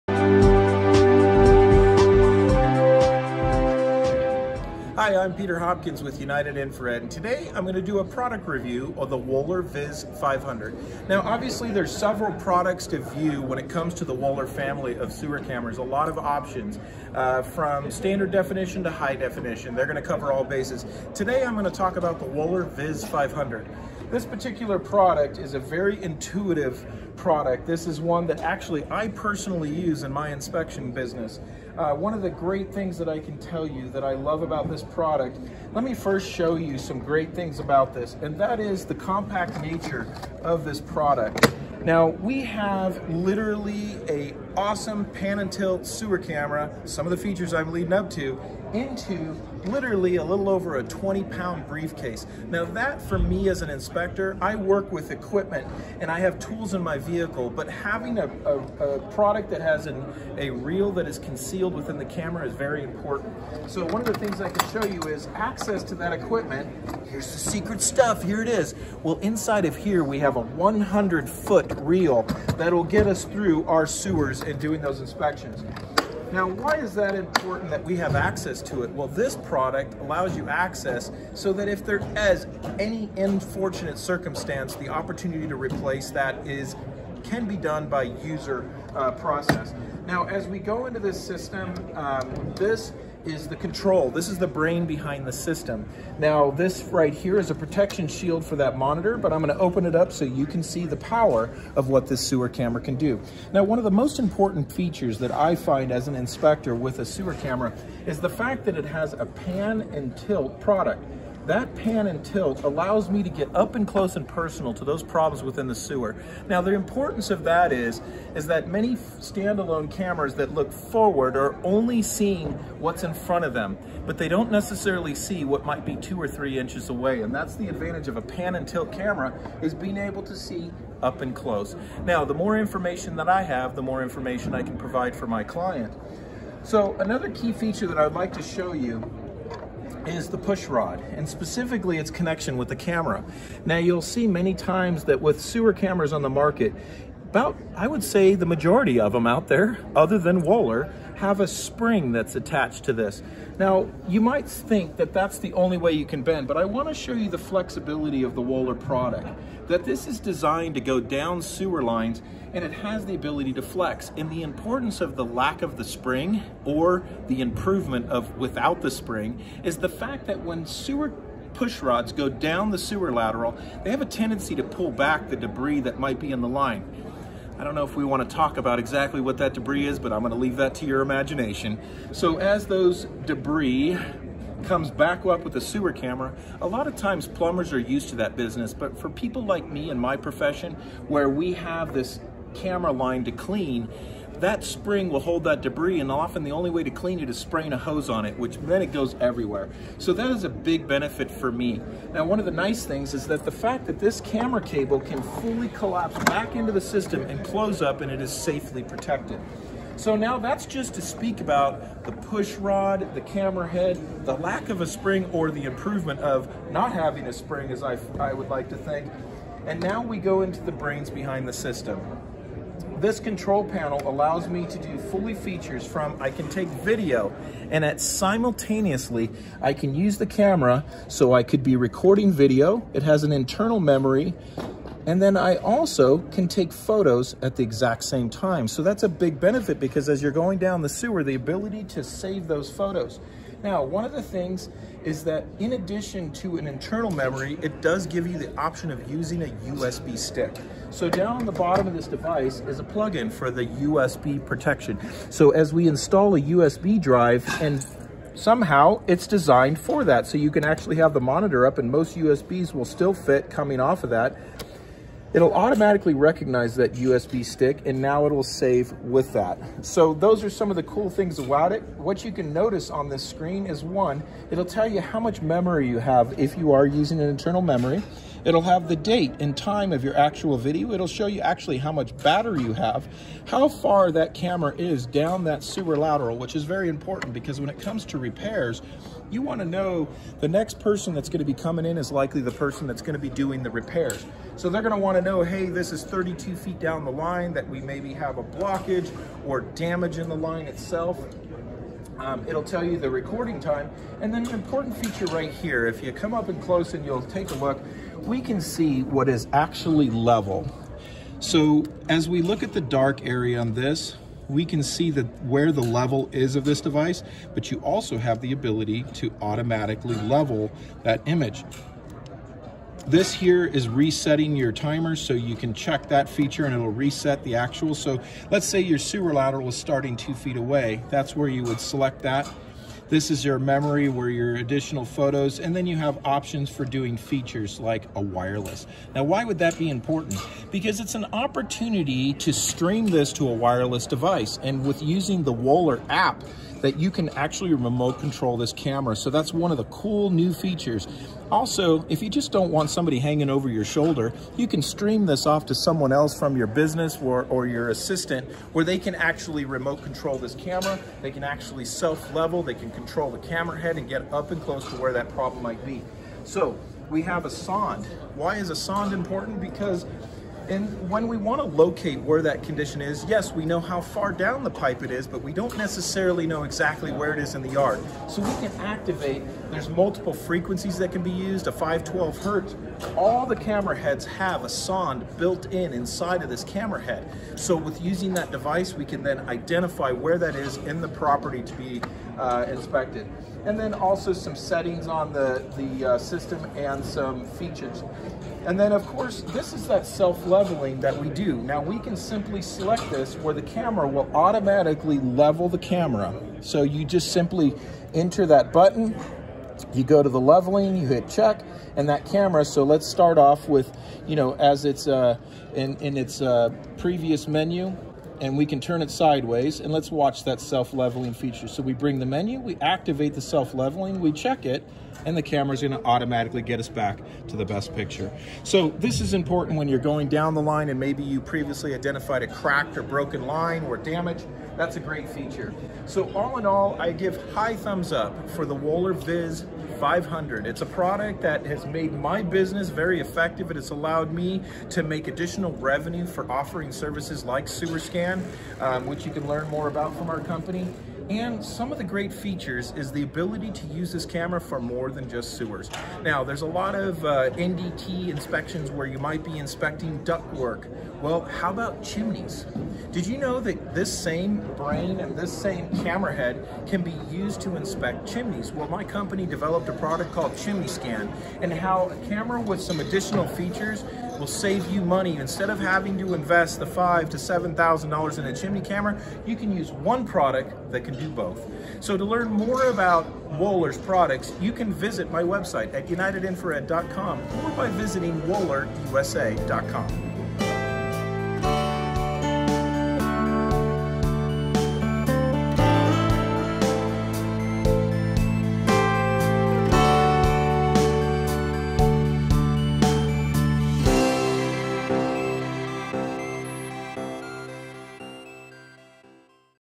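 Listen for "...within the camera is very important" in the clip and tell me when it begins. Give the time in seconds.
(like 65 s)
61 s.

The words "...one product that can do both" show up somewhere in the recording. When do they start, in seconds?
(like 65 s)
479 s.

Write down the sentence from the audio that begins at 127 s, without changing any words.
And that's the advantage of a pan and tilt camera is being able to see up and close.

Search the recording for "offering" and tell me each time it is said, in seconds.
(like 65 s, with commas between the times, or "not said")
446 s.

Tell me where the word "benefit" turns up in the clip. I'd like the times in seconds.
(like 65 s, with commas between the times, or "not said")
200 s, 239 s.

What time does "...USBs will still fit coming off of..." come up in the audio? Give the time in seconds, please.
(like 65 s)
262 s.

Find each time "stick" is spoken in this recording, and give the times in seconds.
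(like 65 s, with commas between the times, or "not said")
250 s, 267 s.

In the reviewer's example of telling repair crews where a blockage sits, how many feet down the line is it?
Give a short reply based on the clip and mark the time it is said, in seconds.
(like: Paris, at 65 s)
32, at 296 s.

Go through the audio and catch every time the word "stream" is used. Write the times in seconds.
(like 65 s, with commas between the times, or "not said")
342 s, 354 s.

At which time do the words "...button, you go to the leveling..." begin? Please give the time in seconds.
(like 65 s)
408 s.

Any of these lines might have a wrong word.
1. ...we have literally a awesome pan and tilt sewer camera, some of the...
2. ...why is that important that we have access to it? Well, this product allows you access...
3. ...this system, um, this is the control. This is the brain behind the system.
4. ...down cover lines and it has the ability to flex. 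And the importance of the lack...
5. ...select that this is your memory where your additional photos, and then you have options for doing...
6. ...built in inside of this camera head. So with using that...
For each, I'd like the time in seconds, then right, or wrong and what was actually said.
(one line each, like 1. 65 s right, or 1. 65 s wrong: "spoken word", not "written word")
1. 42 s right
2. 76 s right
3. 90 s right
4. 160 s wrong: "sewer", not "cover"
5. 331 s right
6. 385 s right.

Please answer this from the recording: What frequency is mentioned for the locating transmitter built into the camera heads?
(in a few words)
512 hertz.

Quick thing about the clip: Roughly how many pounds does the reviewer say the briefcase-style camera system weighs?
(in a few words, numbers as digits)
20.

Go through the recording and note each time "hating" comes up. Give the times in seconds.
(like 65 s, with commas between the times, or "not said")
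not said.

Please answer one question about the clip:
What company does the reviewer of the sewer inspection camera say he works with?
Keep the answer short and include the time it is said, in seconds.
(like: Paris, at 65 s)
United Infrared, at 6 s.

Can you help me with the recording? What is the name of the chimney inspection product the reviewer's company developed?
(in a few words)
Chimney Scan.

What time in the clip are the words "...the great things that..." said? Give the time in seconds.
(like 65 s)
32 s.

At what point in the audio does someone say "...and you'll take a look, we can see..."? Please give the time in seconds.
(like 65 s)
306 s.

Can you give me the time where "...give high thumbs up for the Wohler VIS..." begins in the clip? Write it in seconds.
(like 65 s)
437 s.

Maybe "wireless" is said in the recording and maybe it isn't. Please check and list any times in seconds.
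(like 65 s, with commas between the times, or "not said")
338 s, 343 s.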